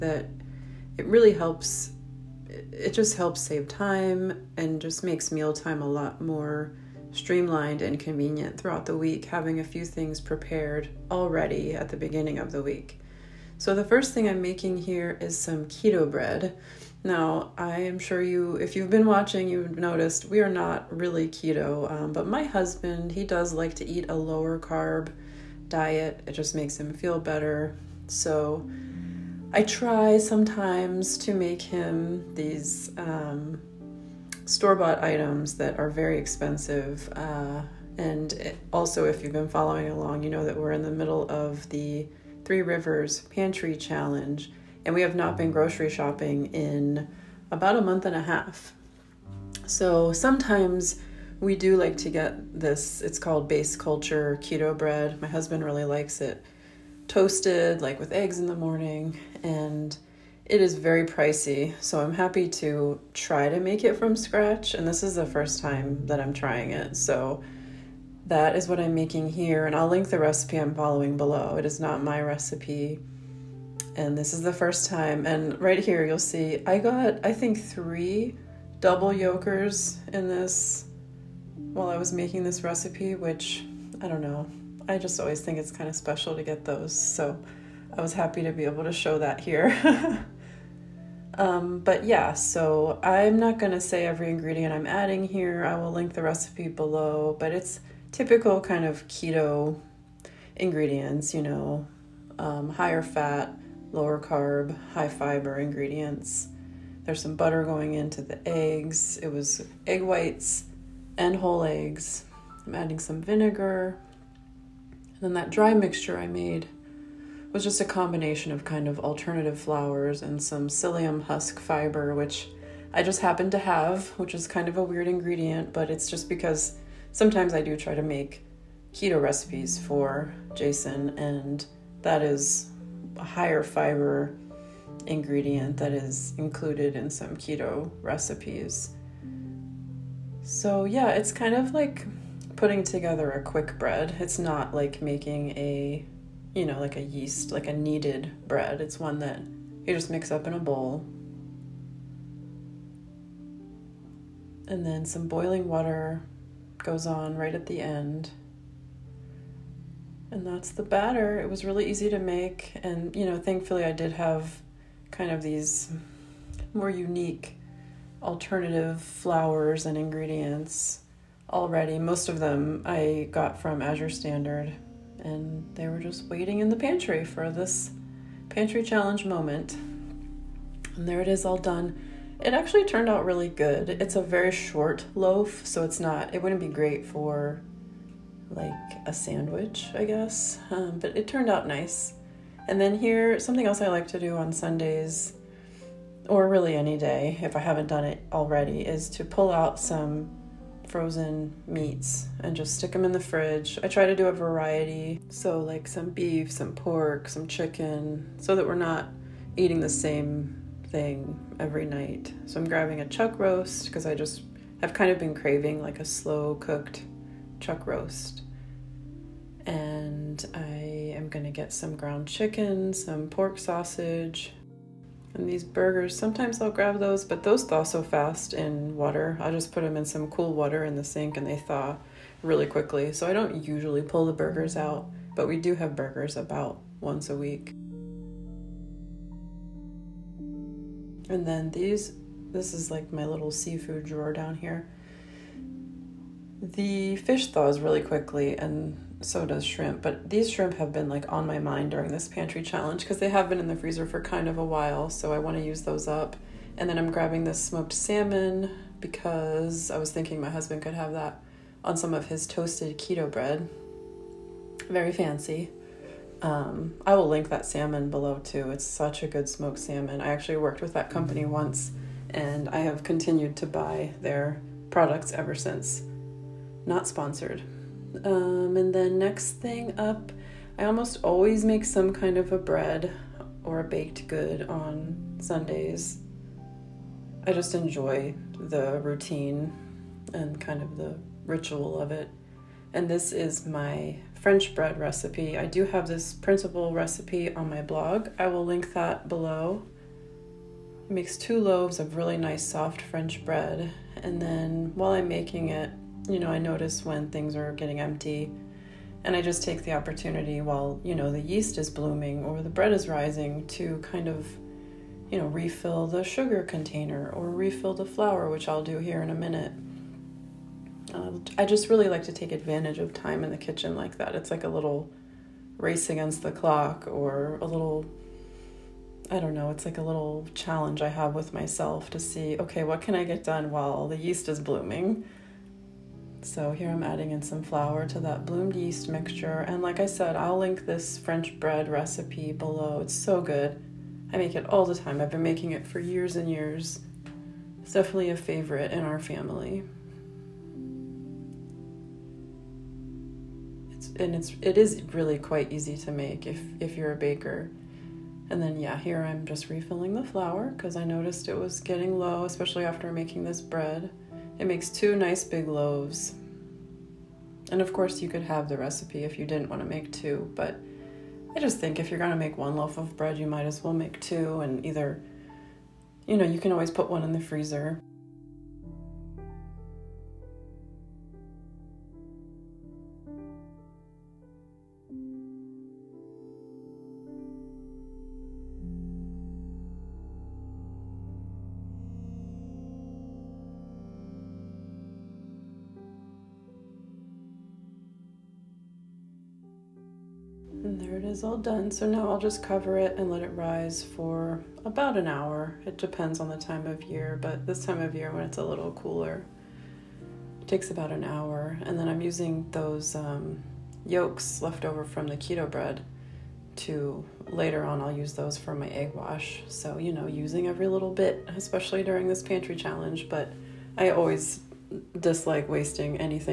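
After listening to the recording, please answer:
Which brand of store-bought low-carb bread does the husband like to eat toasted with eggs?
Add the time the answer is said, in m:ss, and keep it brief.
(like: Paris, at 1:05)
Base Culture, at 0:53.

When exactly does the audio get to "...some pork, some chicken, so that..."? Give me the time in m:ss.
3:26.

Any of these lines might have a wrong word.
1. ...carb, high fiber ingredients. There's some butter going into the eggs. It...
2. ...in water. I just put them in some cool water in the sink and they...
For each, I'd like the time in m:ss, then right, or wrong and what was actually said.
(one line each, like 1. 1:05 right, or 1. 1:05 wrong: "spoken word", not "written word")
1. 1:44 right
2. 3:48 right.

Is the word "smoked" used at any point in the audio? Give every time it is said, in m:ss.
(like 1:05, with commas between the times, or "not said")
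4:17, 4:29.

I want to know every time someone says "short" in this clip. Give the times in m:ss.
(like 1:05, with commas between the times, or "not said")
3:04.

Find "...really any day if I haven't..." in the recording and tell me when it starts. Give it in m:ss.
3:16.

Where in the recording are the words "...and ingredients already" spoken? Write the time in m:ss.
2:49.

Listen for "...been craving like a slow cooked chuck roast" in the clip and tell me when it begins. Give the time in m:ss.
3:35.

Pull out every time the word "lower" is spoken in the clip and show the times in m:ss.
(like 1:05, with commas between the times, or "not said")
0:24, 1:43.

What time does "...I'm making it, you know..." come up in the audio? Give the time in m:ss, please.
5:05.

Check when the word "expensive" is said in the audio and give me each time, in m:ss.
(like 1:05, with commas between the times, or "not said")
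0:36.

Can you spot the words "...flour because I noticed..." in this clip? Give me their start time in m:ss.
6:00.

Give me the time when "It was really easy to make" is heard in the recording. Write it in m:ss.
2:41.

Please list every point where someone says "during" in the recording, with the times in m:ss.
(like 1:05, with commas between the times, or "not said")
4:11, 7:02.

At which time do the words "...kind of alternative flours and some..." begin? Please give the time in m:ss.
1:58.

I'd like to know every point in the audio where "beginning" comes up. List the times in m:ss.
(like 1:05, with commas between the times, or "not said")
0:11.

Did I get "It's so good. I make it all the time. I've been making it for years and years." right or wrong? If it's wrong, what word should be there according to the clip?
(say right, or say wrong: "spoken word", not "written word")
right.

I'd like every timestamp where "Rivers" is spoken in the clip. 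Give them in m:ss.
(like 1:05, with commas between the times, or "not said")
0:42.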